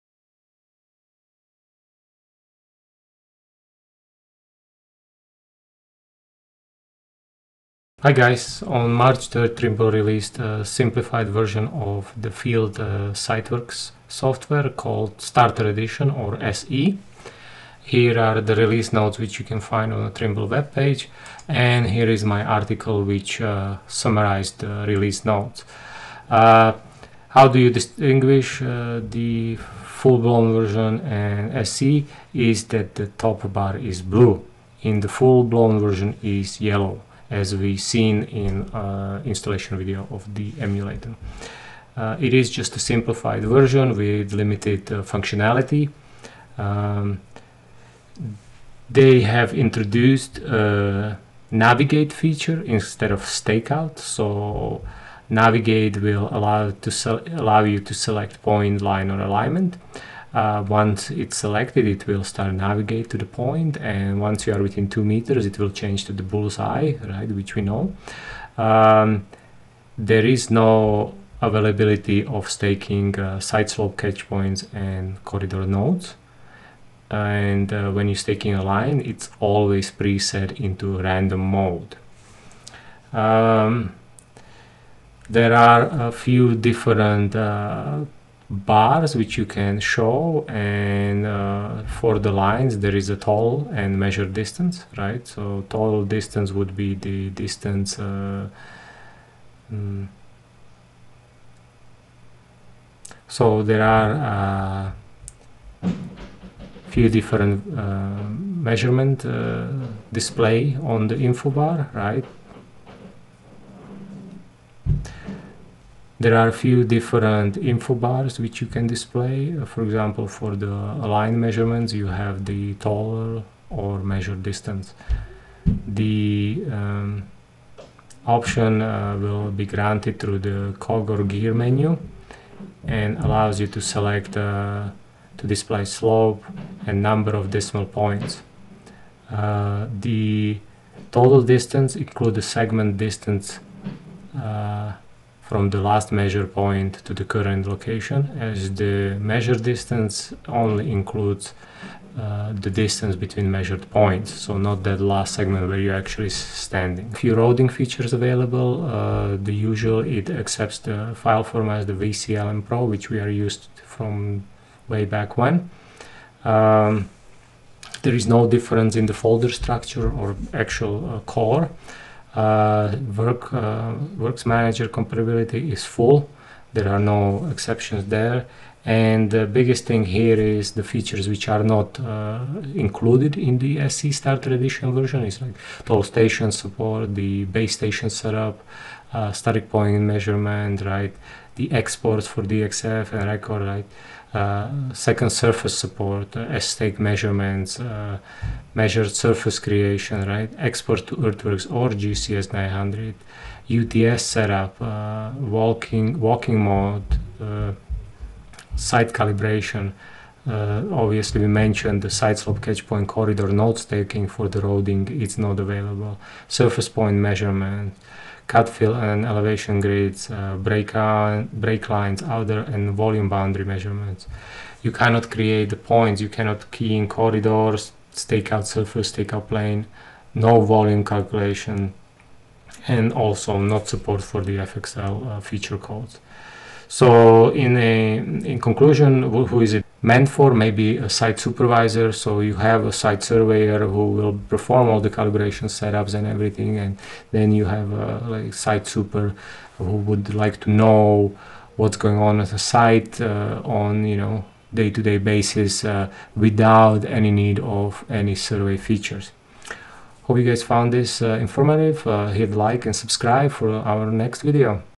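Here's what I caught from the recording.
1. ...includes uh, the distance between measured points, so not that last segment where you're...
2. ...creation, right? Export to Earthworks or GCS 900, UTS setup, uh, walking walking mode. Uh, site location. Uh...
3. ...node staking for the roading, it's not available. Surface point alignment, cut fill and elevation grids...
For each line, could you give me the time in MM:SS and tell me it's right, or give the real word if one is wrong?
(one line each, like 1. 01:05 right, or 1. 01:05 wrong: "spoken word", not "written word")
1. 02:30 right
2. 03:19 wrong: "calibration", not "location"
3. 03:33 wrong: "measurement", not "alignment".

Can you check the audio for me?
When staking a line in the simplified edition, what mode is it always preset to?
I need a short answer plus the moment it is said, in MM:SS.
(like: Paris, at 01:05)
Random mode, at 01:20.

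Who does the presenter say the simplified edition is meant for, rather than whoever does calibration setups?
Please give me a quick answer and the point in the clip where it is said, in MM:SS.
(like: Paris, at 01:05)
Site supervisor, at 04:01.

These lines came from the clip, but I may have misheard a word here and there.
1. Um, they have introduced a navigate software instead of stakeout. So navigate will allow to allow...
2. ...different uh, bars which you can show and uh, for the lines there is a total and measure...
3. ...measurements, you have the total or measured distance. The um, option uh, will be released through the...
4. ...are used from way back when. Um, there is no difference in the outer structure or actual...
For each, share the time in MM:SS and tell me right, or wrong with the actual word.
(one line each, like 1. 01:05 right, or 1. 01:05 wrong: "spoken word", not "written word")
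1. 00:46 wrong: "feature", not "software"
2. 01:26 right
3. 02:01 wrong: "granted", not "released"
4. 02:43 wrong: "folder", not "outer".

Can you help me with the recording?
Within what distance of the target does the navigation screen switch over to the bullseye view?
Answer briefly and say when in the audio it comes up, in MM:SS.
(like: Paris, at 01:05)
2 meters, at 01:04.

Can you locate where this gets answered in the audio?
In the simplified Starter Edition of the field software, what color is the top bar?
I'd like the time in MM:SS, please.
00:34.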